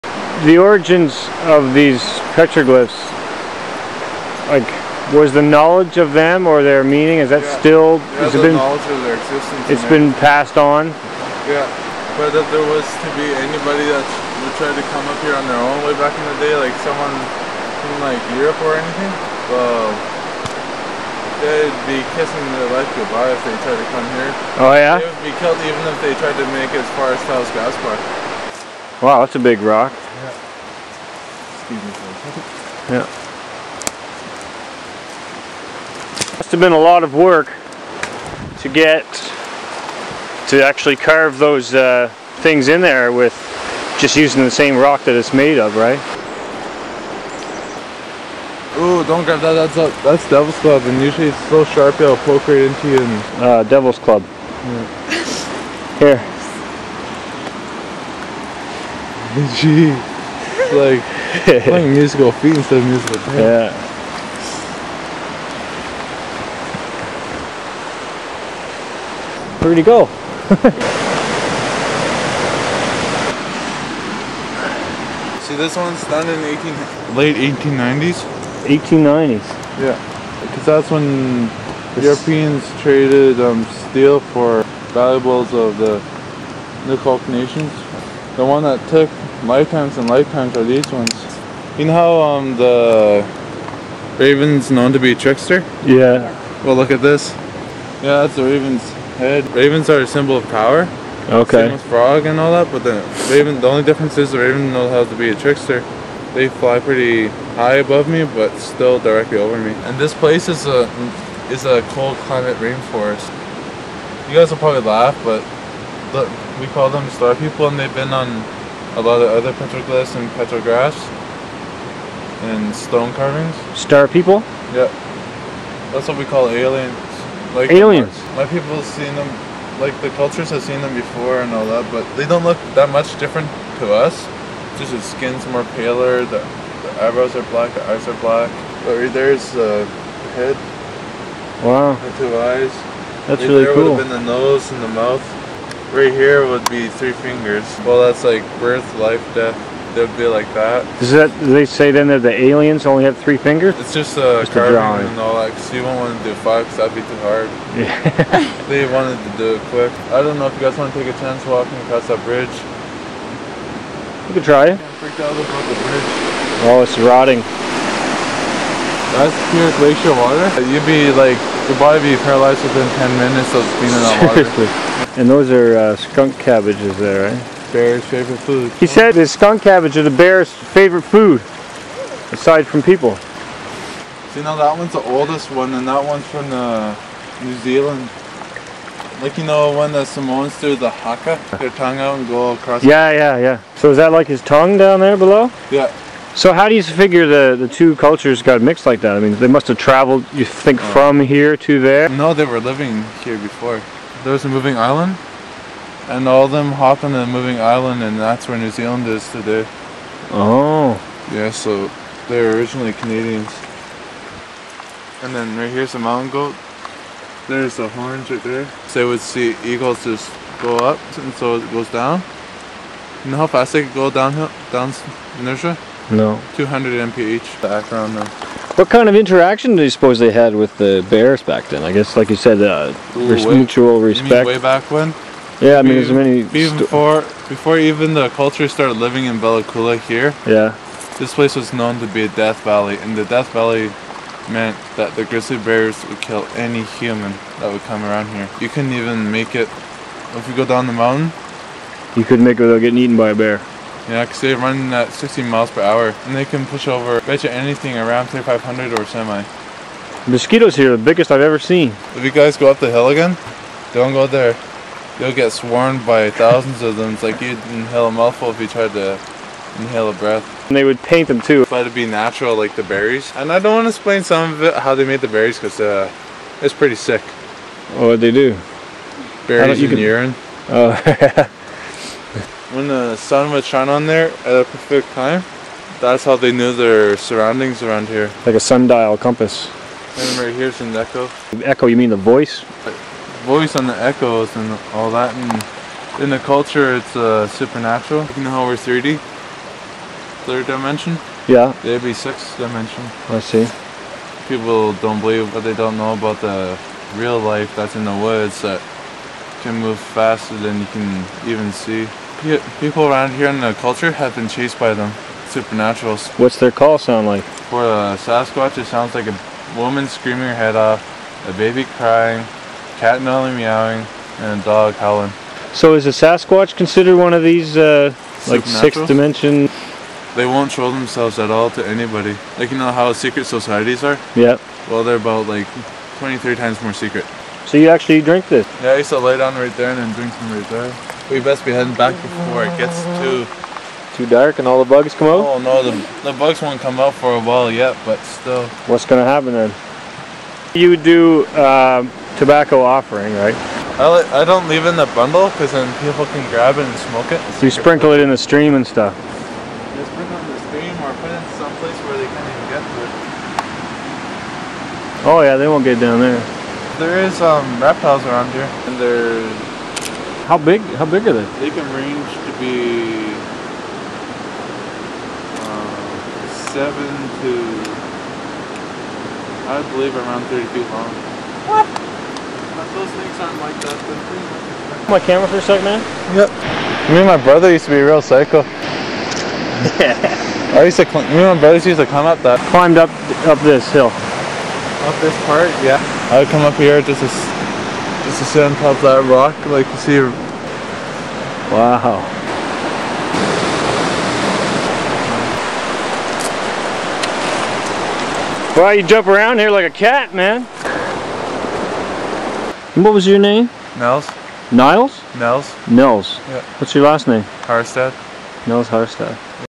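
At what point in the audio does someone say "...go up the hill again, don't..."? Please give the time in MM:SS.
04:22.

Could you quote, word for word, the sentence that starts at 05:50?
You do um, tobacco offering, right?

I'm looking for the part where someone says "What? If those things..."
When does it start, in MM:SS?
06:21.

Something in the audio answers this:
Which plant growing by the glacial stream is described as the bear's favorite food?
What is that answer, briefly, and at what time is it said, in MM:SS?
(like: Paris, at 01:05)
Skunk cabbage, at 02:55.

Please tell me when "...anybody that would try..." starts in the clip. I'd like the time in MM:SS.
00:13.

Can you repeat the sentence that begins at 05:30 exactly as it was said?
They won't show themselves at all to anybody.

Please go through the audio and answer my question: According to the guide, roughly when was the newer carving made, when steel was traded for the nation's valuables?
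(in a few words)
Late 1890s.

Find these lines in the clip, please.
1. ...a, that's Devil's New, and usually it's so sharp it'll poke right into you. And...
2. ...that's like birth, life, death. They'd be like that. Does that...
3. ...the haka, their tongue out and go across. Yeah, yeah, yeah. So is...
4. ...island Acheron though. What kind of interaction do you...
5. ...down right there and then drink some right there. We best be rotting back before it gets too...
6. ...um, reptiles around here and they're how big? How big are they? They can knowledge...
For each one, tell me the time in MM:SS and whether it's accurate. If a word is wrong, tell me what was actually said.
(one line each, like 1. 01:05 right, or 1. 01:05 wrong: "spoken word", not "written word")
1. 00:49 wrong: "Club", not "New"
2. 02:27 right
3. 03:10 right
4. 03:47 wrong: "background", not "island"
5. 05:39 wrong: "heading", not "rotting"
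6. 06:07 wrong: "range", not "knowledge".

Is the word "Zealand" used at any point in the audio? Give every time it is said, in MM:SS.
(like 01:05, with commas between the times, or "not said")
03:07, 03:28.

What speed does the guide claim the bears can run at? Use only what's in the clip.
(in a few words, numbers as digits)
16 miles per hour.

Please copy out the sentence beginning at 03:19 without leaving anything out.
I mean, they must have traveled, you think, oh.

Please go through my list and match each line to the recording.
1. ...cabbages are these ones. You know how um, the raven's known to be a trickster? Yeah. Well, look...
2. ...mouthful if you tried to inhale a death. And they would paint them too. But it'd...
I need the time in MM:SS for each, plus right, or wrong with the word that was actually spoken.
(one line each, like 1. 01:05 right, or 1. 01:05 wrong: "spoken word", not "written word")
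1. 01:30 wrong: "lifetimes", not "cabbages"
2. 04:28 wrong: "breath", not "death".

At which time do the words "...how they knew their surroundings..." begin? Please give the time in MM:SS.
04:46.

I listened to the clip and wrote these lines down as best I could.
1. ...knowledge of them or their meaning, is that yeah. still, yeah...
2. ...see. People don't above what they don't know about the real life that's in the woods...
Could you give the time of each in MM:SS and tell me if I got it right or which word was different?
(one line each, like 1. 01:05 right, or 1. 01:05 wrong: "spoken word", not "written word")
1. 00:05 right
2. 05:03 wrong: "believe", not "above".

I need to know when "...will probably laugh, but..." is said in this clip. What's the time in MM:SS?
01:54.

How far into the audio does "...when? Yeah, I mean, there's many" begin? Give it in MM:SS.
03:54.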